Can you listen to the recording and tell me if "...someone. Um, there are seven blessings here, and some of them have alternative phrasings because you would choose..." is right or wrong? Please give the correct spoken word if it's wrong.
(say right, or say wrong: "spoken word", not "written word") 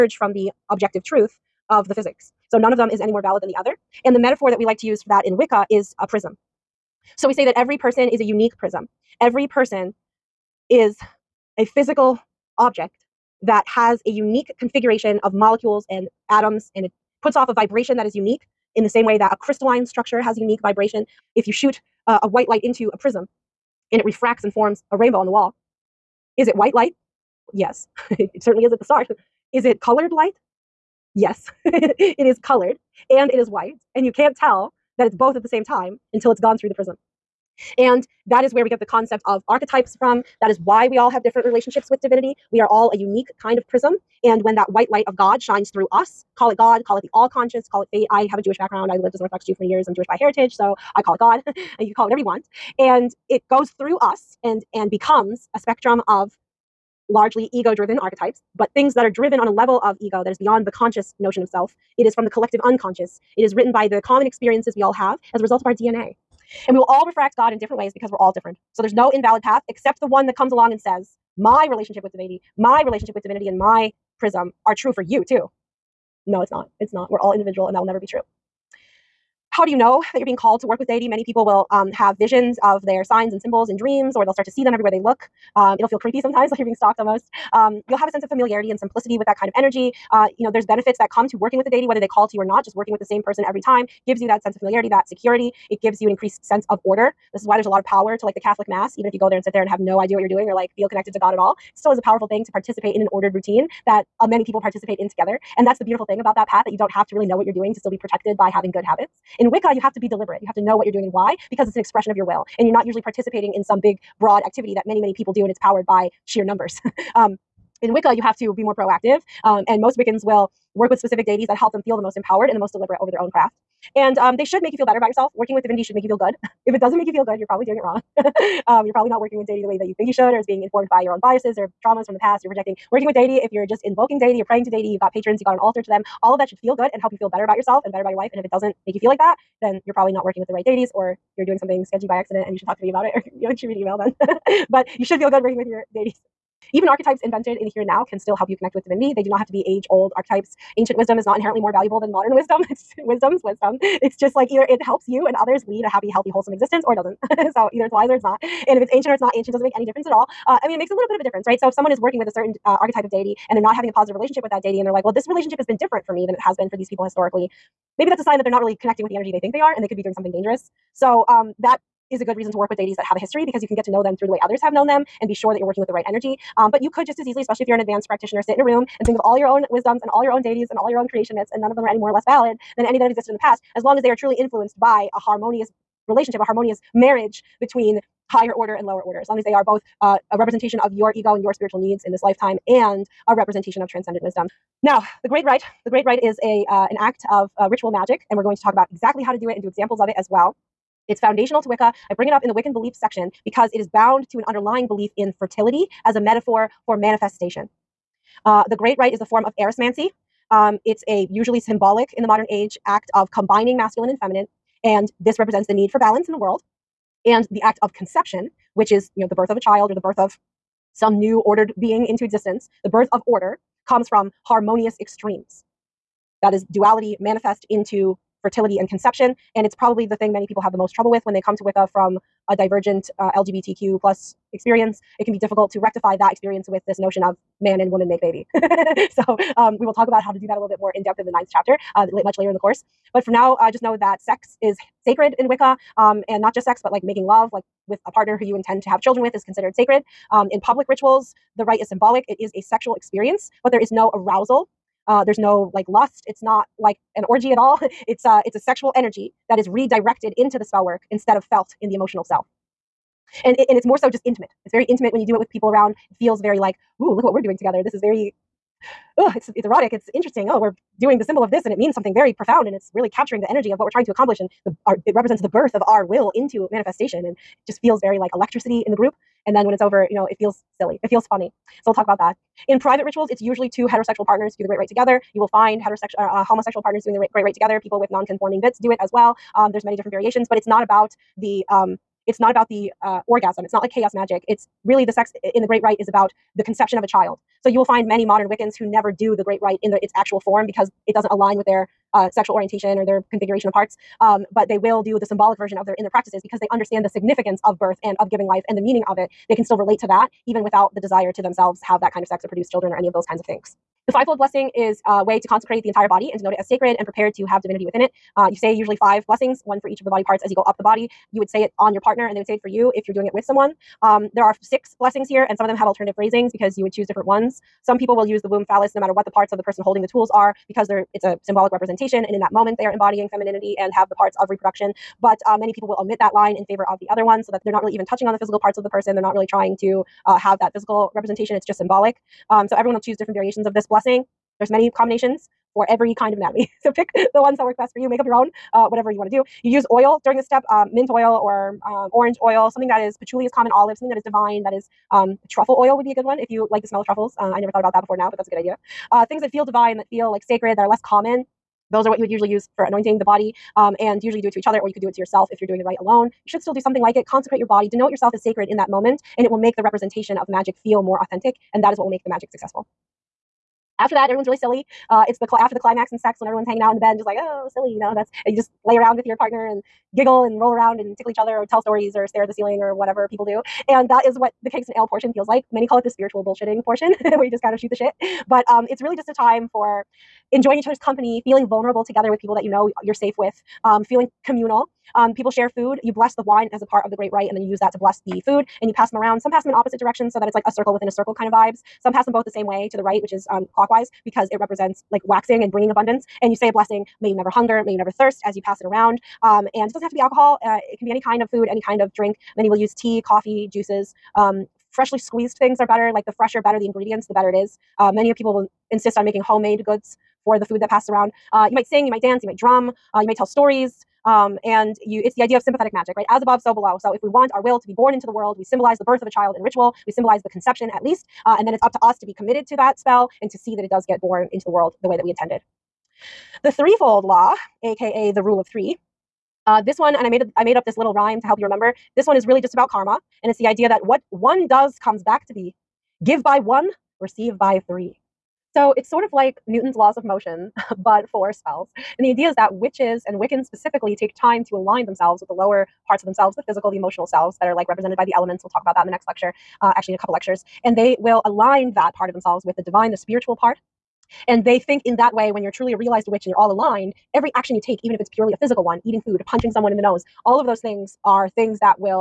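wrong: "six", not "seven".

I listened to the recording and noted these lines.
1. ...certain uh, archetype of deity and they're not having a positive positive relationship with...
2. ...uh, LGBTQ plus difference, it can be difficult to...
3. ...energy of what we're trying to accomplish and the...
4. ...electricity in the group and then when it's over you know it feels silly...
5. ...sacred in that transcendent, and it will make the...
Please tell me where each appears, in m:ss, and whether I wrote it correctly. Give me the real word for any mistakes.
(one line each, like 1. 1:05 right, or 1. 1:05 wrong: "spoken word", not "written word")
1. 2:42 right
2. 3:53 wrong: "experience", not "difference"
3. 4:33 right
4. 4:38 right
5. 6:08 wrong: "moment", not "transcendent".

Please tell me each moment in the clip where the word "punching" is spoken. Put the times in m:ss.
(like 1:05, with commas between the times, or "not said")
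7:49.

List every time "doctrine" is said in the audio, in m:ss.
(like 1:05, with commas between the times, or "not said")
not said.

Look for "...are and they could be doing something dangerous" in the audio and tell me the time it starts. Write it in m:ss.
2:49.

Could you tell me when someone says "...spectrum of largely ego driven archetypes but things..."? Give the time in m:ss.
0:55.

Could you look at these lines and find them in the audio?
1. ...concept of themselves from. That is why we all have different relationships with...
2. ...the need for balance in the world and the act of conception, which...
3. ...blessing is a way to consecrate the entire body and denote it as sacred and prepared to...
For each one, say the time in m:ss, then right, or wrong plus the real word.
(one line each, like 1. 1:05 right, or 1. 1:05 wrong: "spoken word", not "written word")
1. 0:38 wrong: "archetypes", not "themselves"
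2. 3:35 right
3. 5:14 right.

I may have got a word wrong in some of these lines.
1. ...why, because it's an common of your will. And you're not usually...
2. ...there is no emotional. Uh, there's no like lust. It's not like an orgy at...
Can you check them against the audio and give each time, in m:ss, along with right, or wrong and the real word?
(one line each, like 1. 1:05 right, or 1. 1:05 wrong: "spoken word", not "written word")
1. 1:51 wrong: "expression", not "common"
2. 4:13 wrong: "arousal", not "emotional".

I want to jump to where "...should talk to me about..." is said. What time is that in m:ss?
2:22.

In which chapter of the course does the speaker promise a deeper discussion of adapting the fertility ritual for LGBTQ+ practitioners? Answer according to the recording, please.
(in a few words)
Ninth chapter.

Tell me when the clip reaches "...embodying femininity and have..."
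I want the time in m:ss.
5:32.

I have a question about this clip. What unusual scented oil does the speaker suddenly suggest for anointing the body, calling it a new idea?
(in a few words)
Truffle oil.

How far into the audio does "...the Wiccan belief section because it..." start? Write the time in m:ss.
3:22.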